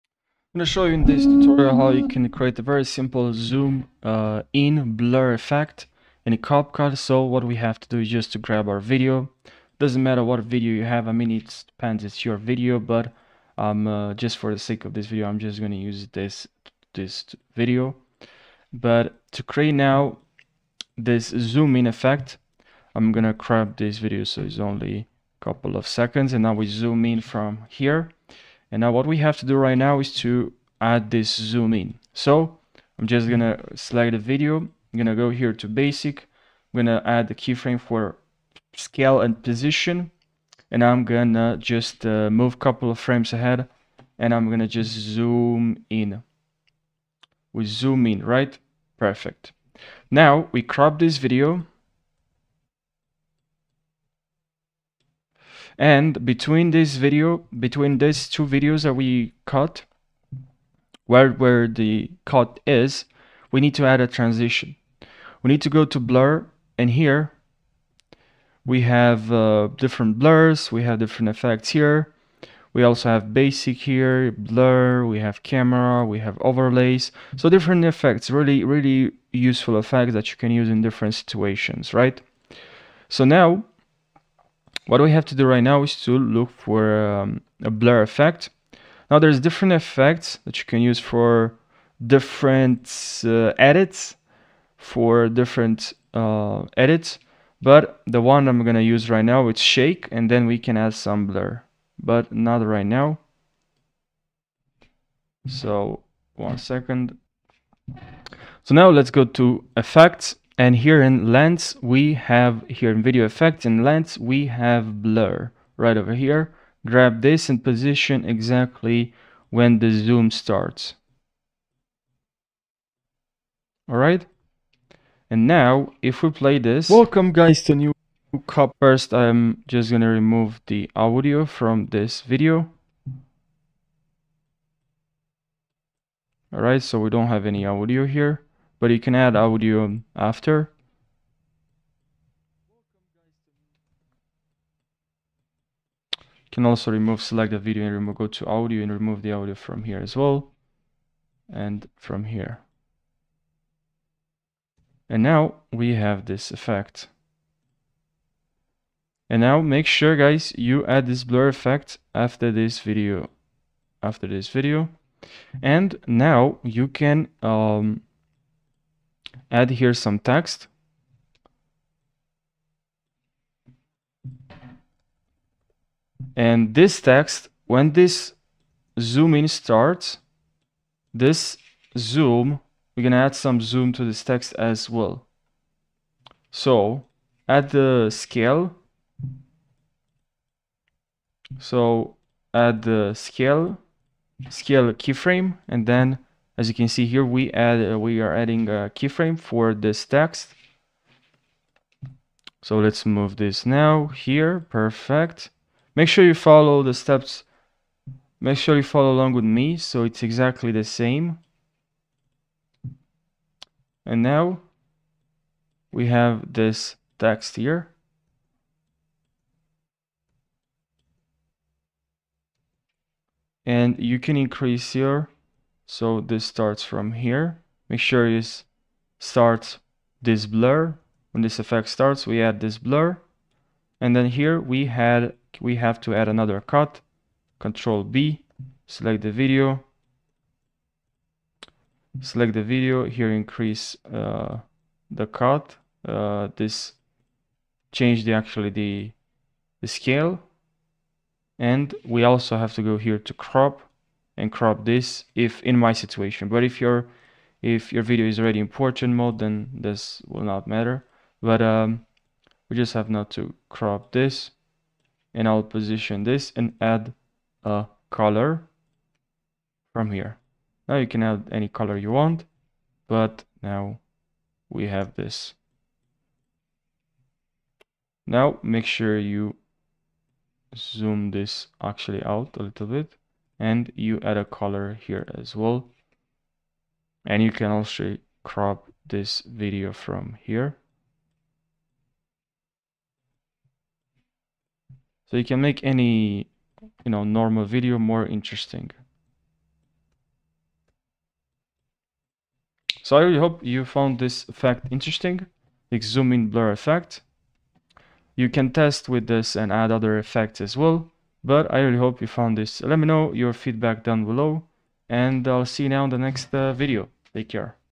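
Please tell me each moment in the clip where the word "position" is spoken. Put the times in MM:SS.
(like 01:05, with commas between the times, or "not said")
00:39, 01:57, 04:25.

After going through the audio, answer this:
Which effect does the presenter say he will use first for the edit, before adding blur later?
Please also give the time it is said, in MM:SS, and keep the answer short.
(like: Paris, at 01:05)
shake, at 01:39.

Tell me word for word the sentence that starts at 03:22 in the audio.
So let's move this now here.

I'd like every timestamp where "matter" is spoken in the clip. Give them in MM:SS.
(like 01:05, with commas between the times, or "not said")
00:10, 04:20.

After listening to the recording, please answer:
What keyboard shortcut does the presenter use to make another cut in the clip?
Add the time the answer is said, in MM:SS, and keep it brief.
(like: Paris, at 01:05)
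Control B, at 03:57.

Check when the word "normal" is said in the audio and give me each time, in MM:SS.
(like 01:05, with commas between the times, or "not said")
04:57.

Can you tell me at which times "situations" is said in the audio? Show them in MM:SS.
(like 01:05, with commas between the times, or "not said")
01:21, 04:15.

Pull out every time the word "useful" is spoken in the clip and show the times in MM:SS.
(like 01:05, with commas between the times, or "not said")
01:19.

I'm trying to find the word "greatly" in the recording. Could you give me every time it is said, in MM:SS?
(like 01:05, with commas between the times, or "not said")
not said.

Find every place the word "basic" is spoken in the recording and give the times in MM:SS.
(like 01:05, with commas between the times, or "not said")
00:35, 01:13.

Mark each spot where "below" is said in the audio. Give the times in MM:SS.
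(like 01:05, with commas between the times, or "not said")
05:14.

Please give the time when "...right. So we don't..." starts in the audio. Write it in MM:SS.
02:16.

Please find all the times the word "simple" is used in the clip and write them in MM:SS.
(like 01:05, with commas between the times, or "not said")
00:02.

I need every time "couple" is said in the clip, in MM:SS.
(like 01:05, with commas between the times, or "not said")
00:25, 00:42.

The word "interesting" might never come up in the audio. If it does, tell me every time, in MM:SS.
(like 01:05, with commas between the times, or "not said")
04:58, 05:04.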